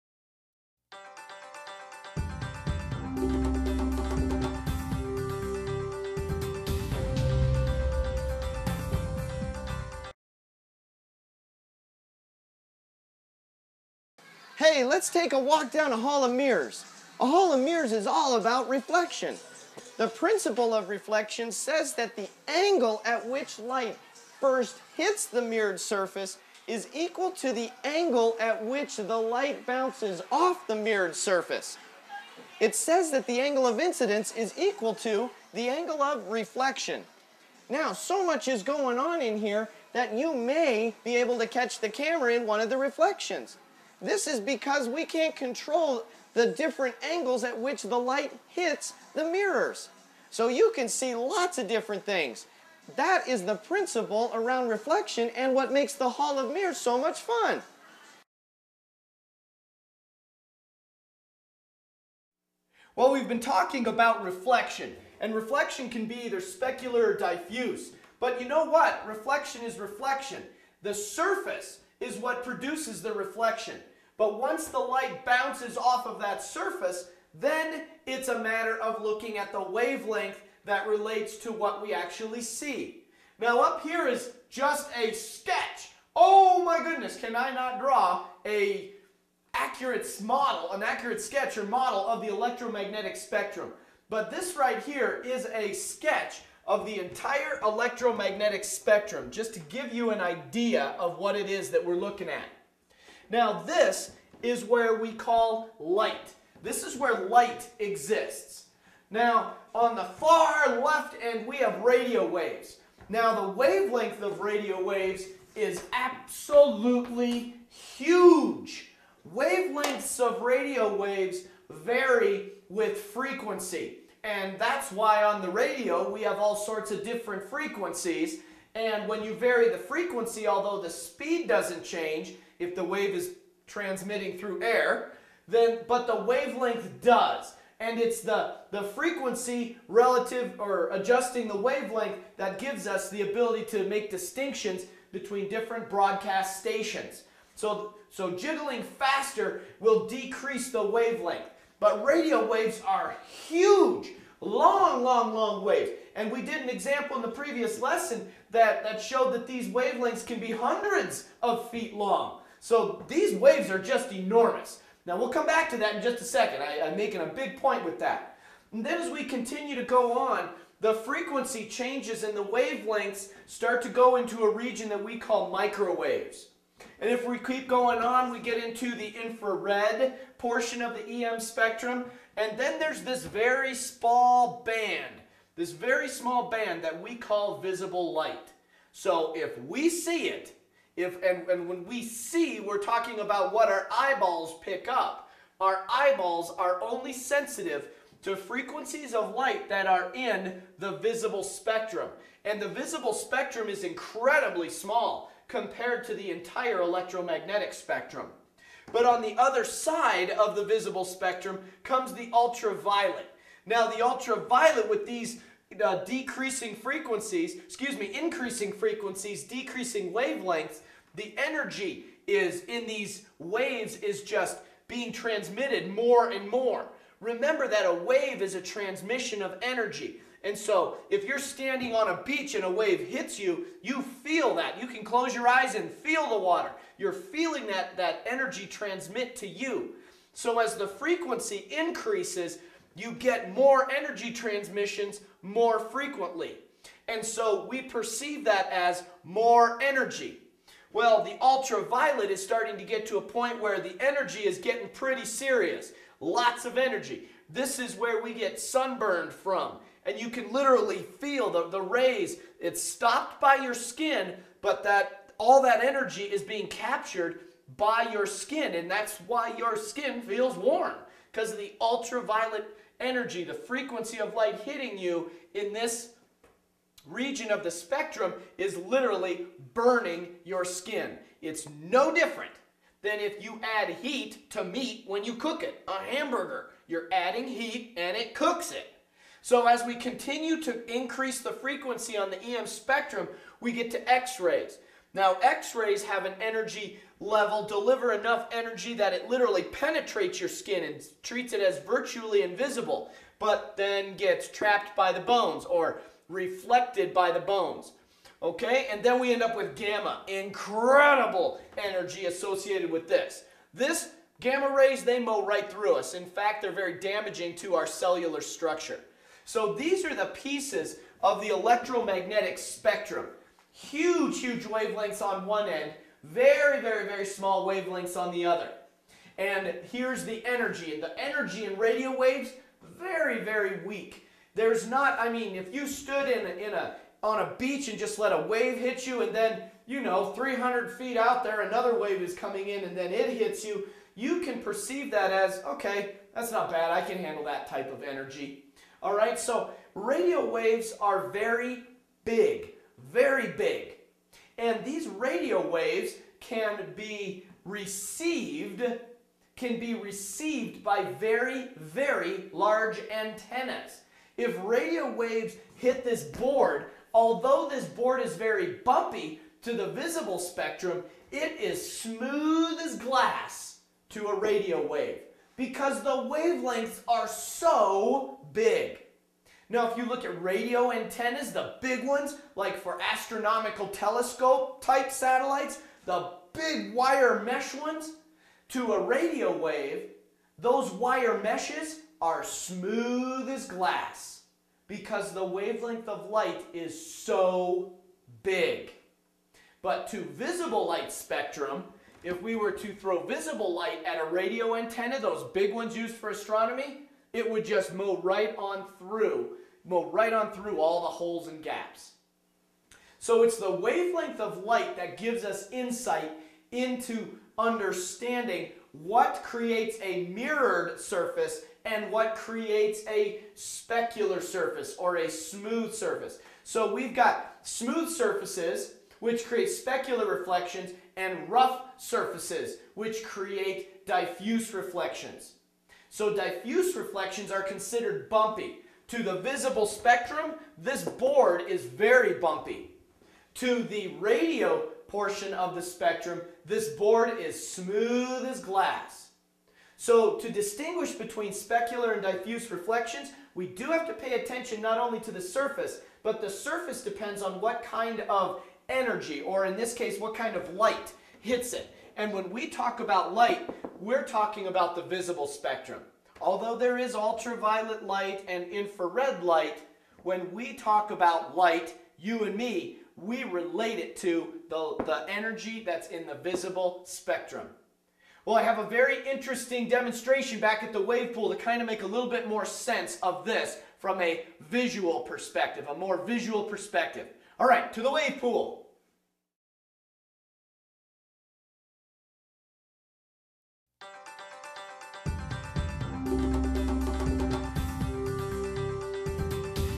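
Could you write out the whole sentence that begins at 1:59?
Wavelengths of radio waves vary with frequency.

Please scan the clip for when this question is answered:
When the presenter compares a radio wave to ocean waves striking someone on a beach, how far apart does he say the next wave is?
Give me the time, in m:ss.
5:40.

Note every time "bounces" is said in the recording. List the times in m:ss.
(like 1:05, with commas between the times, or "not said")
0:29, 1:15.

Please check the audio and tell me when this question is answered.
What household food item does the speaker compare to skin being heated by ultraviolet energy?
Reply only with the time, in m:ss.
4:45.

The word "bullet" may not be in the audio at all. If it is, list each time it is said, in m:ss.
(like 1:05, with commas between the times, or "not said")
not said.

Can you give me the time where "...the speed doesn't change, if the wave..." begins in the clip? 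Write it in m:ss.
2:10.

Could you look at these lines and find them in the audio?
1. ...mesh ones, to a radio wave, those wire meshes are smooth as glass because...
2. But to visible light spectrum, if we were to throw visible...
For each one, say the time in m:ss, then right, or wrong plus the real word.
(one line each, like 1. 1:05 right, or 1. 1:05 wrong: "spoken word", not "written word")
1. 6:27 right
2. 6:39 right.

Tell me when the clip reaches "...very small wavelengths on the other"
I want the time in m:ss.
5:27.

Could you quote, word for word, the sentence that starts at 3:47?
Remember that a wave is a transmission of energy.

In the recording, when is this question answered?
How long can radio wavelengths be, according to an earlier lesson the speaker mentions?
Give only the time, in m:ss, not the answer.
2:40.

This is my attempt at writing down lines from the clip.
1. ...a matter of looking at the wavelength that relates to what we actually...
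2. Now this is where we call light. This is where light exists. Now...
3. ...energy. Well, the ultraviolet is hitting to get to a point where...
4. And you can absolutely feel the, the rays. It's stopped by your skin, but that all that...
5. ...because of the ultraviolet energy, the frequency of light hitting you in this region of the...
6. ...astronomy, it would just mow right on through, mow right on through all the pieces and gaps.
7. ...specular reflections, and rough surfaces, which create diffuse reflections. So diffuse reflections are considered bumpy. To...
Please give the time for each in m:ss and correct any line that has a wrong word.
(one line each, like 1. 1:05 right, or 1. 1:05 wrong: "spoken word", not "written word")
1. 1:18 right
2. 1:43 right
3. 4:09 wrong: "starting", not "hitting"
4. 4:20 wrong: "literally", not "absolutely"
5. 4:31 right
6. 6:46 wrong: "holes", not "pieces"
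7. 7:09 right.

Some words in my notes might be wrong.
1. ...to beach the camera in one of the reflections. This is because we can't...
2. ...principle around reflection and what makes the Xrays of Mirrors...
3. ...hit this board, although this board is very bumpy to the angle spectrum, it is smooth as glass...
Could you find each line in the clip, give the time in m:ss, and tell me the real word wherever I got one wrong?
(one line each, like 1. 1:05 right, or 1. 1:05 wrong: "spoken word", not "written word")
1. 0:41 wrong: "catch", not "beach"
2. 0:53 wrong: "Hall", not "Xrays"
3. 6:05 wrong: "visible", not "angle".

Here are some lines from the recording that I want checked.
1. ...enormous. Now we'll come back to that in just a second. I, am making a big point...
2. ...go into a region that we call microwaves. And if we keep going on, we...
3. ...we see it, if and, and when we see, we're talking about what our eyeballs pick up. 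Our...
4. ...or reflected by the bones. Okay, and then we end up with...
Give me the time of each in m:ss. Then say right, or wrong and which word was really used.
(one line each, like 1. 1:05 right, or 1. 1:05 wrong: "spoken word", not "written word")
1. 2:44 right
2. 2:53 right
3. 3:09 right
4. 5:05 right.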